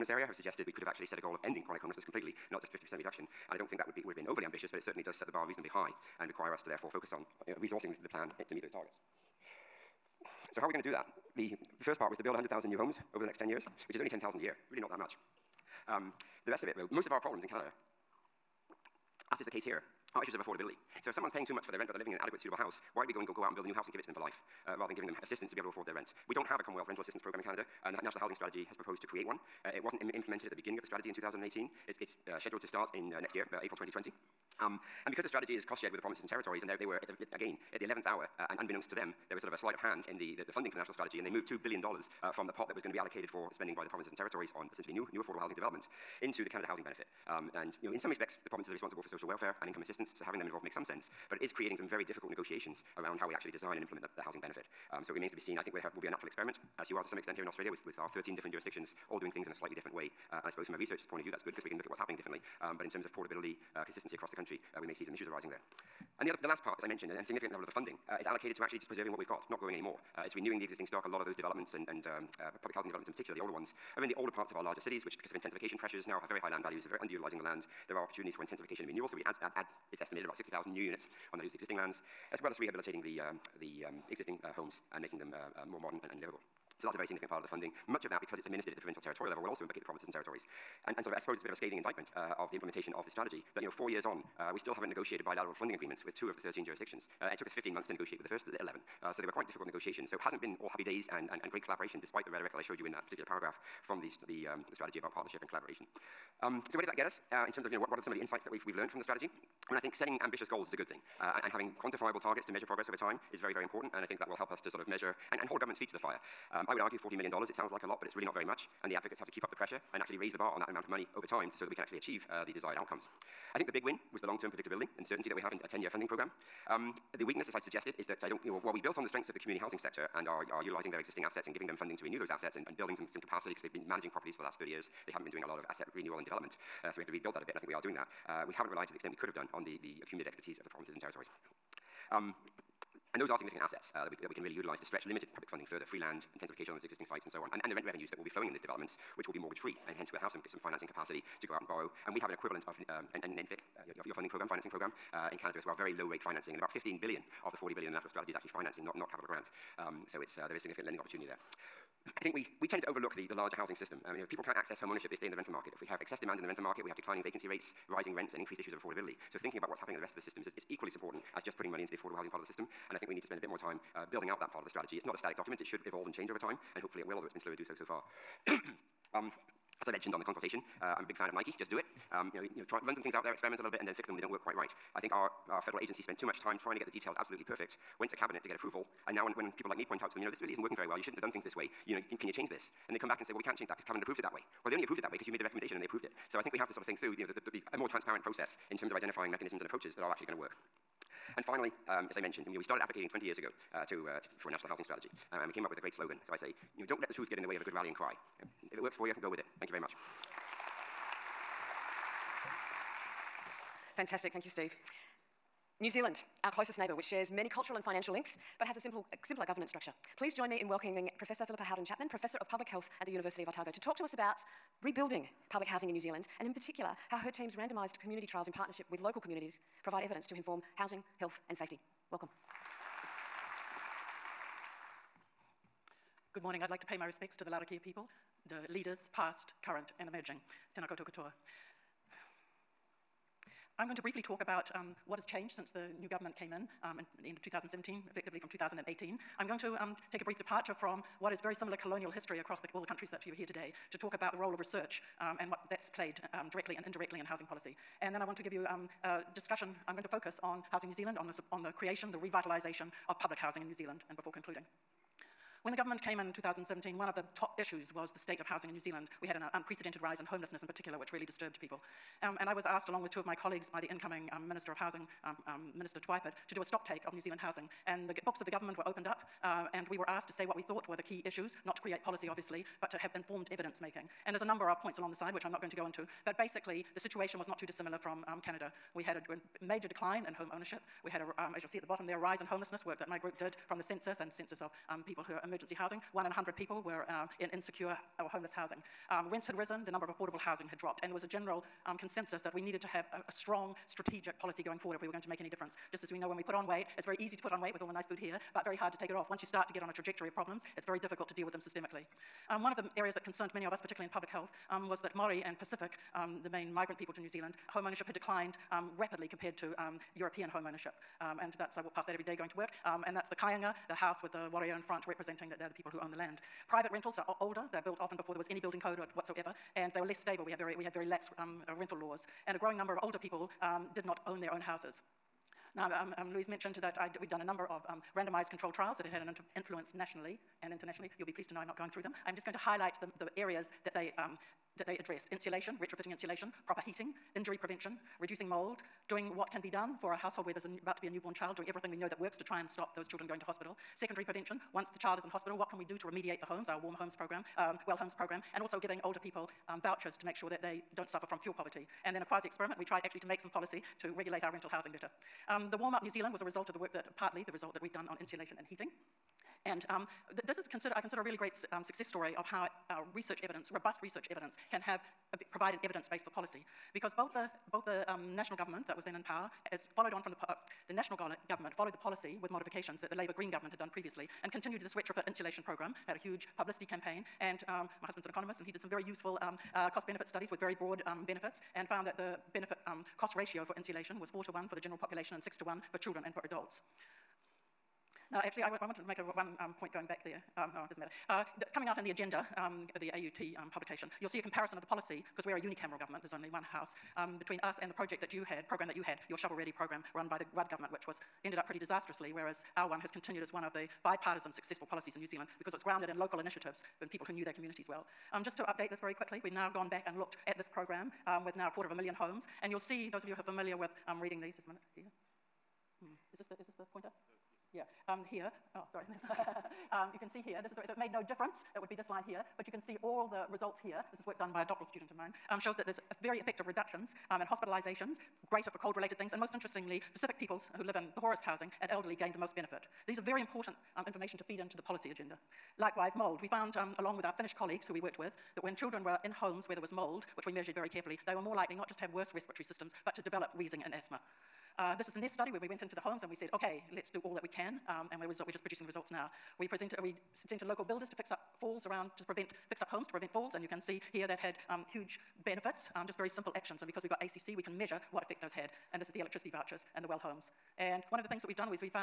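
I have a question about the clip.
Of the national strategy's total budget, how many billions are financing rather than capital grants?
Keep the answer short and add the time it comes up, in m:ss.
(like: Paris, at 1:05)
15 billion, at 2:36.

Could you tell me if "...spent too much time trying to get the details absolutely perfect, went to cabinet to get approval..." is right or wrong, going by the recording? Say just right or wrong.
right.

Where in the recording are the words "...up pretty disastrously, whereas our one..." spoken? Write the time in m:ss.
6:51.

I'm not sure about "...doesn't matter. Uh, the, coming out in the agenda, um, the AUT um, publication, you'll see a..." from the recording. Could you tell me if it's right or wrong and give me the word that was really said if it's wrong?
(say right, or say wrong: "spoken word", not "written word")
right.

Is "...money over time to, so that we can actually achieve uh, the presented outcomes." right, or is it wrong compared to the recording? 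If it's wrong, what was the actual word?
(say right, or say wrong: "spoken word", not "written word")
wrong: "desired", not "presented".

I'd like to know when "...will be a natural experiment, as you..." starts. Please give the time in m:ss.
0:55.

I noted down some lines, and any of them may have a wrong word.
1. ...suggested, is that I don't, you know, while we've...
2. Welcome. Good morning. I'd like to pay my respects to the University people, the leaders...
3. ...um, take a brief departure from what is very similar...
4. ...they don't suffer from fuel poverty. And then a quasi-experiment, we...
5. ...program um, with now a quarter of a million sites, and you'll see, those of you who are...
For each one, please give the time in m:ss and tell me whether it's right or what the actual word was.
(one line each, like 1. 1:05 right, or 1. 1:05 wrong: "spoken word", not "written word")
1. 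2:07 right
2. 3:52 wrong: "Larrakia", not "University"
3. 4:09 right
4. 6:00 right
5. 7:00 wrong: "homes", not "sites".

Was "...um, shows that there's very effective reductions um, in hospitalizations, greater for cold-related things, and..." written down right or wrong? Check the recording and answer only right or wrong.
right.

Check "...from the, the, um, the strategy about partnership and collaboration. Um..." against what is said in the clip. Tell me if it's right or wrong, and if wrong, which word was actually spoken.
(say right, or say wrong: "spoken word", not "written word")
right.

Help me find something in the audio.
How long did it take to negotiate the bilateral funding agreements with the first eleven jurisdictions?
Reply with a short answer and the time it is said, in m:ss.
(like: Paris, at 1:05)
15 months, at 1:37.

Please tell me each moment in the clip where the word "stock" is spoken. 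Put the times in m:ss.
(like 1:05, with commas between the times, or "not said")
1:10, 4:36.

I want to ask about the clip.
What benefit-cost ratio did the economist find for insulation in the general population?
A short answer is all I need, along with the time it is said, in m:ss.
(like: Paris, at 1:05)
4 to 1, at 6:34.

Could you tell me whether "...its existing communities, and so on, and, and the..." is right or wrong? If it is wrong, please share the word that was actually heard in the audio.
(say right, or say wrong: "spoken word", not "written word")
wrong: "sites", not "communities".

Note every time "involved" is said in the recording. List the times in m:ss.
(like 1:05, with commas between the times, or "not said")
0:50.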